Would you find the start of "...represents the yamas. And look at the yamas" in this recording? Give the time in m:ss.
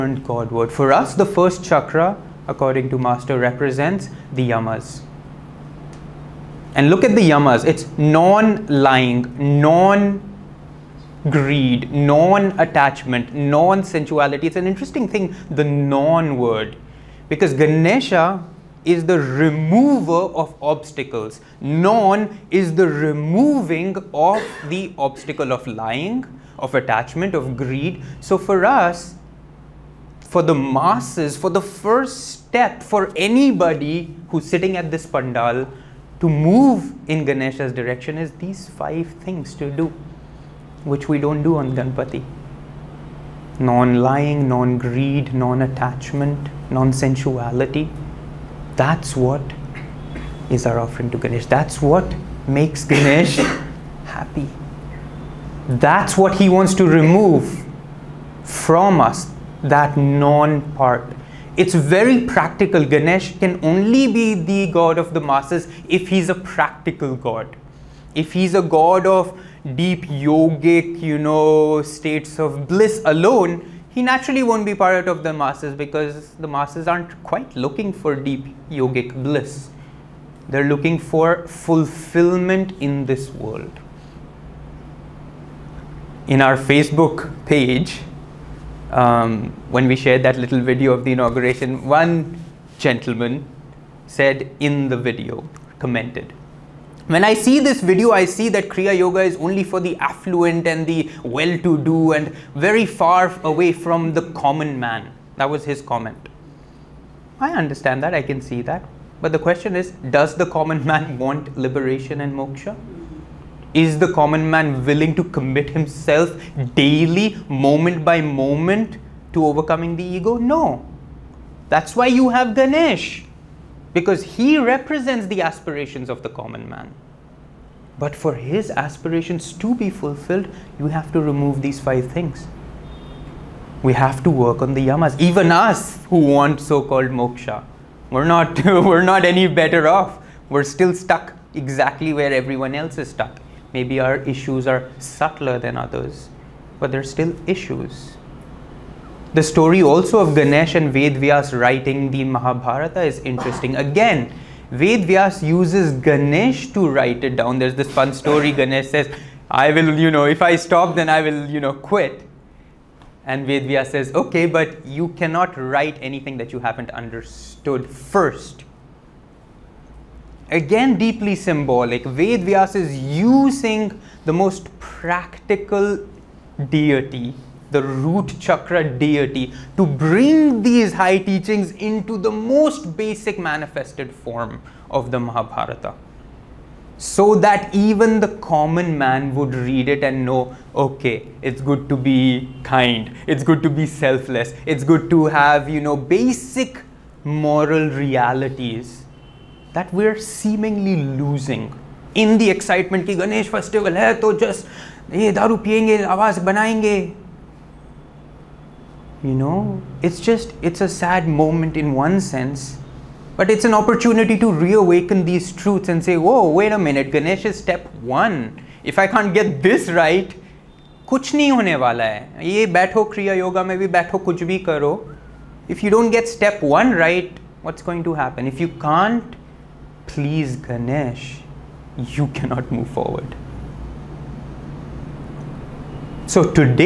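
0:03.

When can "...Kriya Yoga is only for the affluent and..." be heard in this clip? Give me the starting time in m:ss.
1:38.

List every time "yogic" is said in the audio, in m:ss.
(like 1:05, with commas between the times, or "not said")
1:10, 1:18.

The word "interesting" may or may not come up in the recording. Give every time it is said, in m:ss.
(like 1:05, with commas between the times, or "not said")
0:14, 2:33.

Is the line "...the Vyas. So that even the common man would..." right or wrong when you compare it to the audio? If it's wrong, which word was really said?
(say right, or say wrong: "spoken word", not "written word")
wrong: "Mahabharata", not "Vyas".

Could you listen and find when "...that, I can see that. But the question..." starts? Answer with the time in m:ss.
1:48.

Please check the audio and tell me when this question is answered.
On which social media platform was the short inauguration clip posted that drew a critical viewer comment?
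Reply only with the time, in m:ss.
1:26.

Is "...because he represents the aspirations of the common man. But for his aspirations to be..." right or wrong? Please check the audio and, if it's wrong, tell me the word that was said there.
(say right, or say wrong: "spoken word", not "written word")
right.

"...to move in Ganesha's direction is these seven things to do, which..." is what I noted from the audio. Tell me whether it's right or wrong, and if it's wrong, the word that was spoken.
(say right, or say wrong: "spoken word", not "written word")
wrong: "five", not "seven".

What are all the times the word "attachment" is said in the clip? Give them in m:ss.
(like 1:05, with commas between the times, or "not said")
0:11, 0:26, 0:45.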